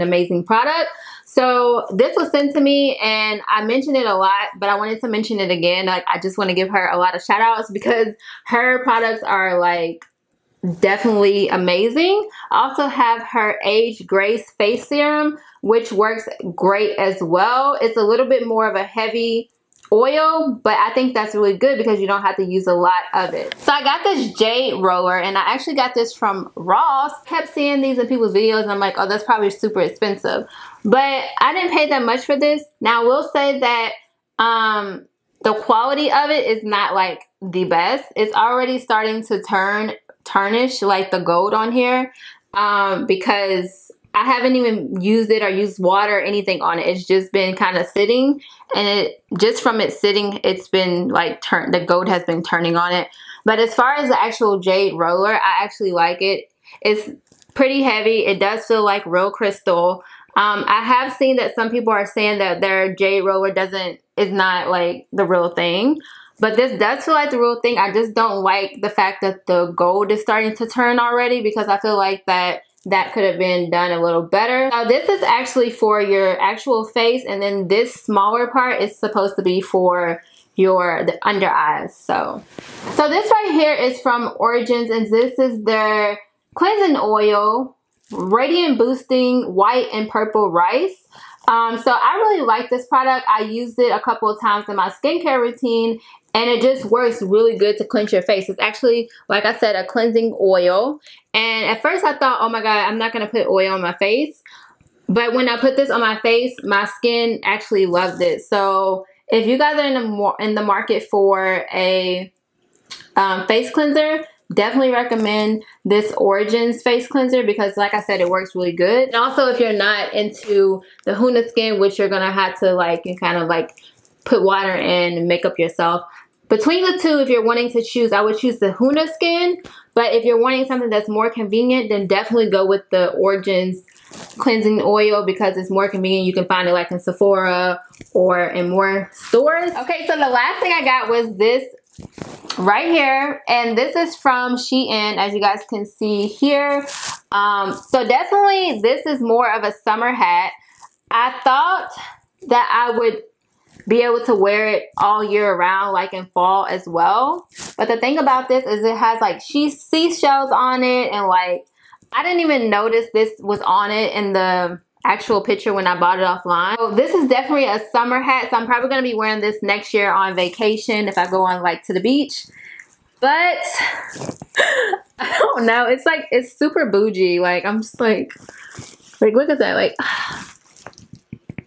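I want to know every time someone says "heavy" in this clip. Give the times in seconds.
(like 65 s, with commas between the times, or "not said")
18 s, 57 s.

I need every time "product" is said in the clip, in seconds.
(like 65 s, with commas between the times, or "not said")
0 s, 8 s, 92 s.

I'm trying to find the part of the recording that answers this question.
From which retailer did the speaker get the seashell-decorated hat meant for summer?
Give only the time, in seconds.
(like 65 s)
144 s.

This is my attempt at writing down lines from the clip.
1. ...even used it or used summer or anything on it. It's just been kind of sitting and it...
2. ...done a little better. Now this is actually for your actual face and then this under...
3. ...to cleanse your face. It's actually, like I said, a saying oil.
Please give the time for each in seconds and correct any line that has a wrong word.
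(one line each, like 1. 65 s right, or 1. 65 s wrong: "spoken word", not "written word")
1. 44 s wrong: "water", not "summer"
2. 73 s wrong: "smaller", not "under"
3. 97 s wrong: "cleansing", not "saying".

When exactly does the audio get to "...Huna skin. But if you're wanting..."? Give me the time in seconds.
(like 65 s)
128 s.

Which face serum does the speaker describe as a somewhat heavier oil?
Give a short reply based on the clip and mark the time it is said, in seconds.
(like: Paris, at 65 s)
Age Grace Face Serum, at 13 s.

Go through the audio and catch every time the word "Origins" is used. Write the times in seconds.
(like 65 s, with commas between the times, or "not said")
84 s, 116 s, 133 s.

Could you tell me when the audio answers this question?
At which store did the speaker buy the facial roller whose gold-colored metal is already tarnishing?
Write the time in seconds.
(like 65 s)
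26 s.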